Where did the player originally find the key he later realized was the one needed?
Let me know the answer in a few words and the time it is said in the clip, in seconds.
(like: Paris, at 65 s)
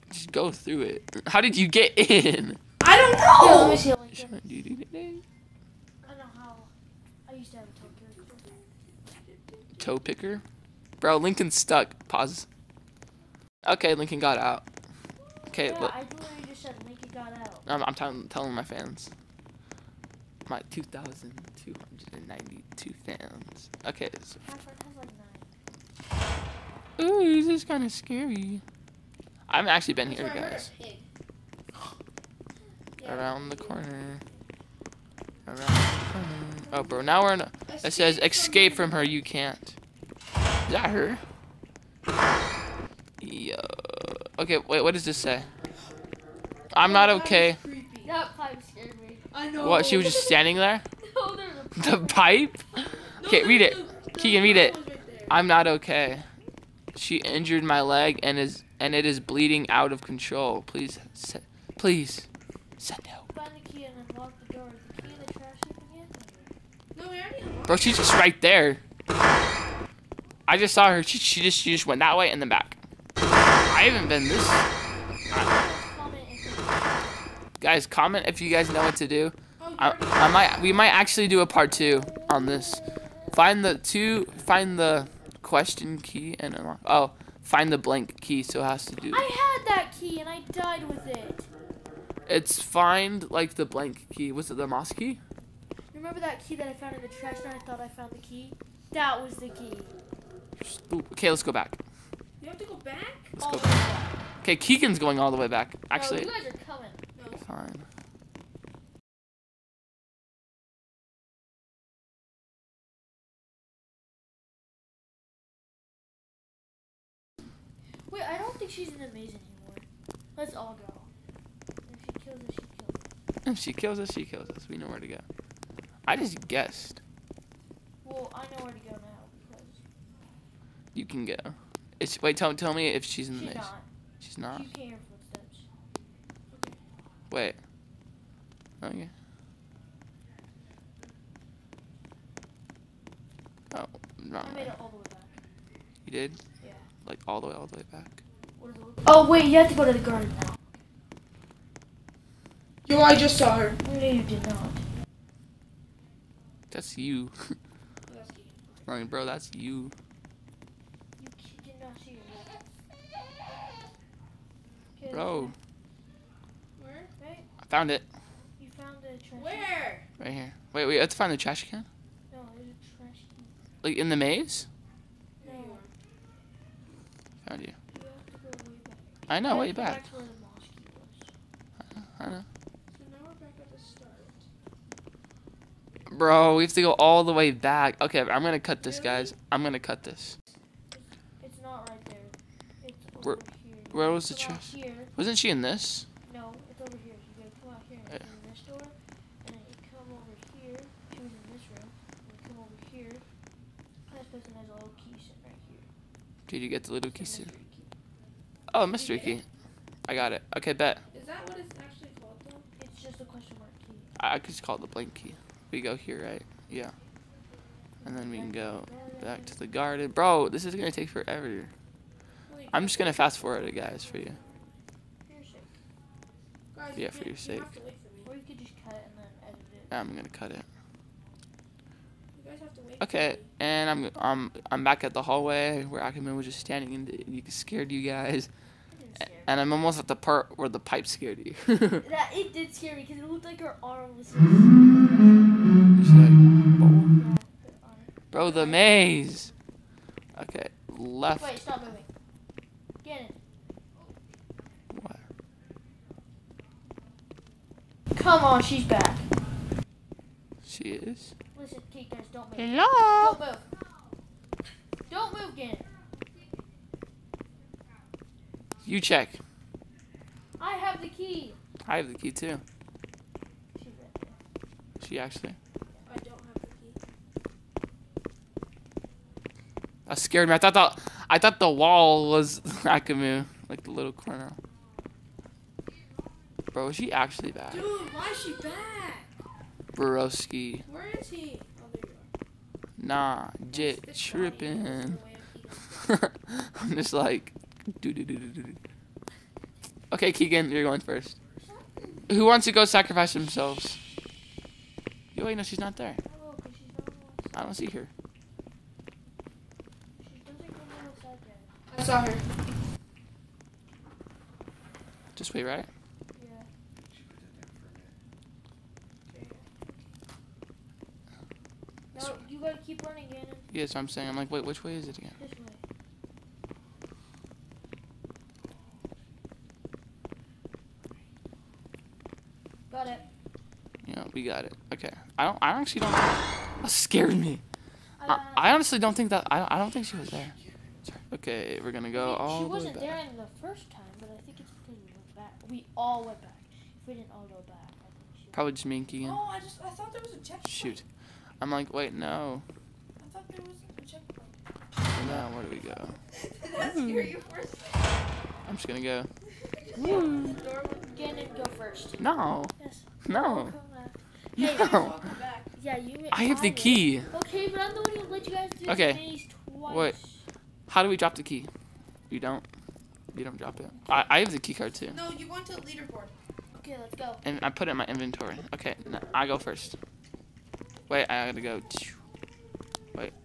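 in the trash, at 96 s.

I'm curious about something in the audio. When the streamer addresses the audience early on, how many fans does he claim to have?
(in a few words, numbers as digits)
2,292.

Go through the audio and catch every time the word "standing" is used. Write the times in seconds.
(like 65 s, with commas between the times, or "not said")
50 s, 236 s.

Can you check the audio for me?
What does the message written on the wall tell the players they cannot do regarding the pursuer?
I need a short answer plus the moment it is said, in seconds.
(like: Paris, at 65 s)
escape from her, at 38 s.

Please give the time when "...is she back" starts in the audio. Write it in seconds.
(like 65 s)
288 s.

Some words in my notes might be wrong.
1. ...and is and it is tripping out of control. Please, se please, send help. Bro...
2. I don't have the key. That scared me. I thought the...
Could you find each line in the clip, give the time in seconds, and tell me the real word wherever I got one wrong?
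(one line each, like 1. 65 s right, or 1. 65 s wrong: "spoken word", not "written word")
1. 58 s wrong: "bleeding", not "tripping"
2. 276 s right.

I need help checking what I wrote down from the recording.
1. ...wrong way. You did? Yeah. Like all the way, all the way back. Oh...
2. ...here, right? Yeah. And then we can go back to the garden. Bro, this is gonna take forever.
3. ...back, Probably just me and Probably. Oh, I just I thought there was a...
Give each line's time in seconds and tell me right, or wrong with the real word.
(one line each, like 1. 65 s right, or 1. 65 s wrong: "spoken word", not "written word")
1. 144 s right
2. 215 s right
3. 347 s wrong: "Keegan", not "Probably".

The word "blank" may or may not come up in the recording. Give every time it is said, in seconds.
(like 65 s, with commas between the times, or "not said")
87 s, 93 s, 214 s.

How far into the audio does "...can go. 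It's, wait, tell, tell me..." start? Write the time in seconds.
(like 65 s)
131 s.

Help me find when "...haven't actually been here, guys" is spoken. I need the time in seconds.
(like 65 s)
29 s.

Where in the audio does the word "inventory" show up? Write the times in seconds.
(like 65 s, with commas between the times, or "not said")
378 s.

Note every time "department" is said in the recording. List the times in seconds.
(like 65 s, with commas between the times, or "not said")
not said.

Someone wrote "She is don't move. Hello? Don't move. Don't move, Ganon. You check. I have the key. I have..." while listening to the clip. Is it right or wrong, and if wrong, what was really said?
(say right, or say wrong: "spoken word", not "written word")
right.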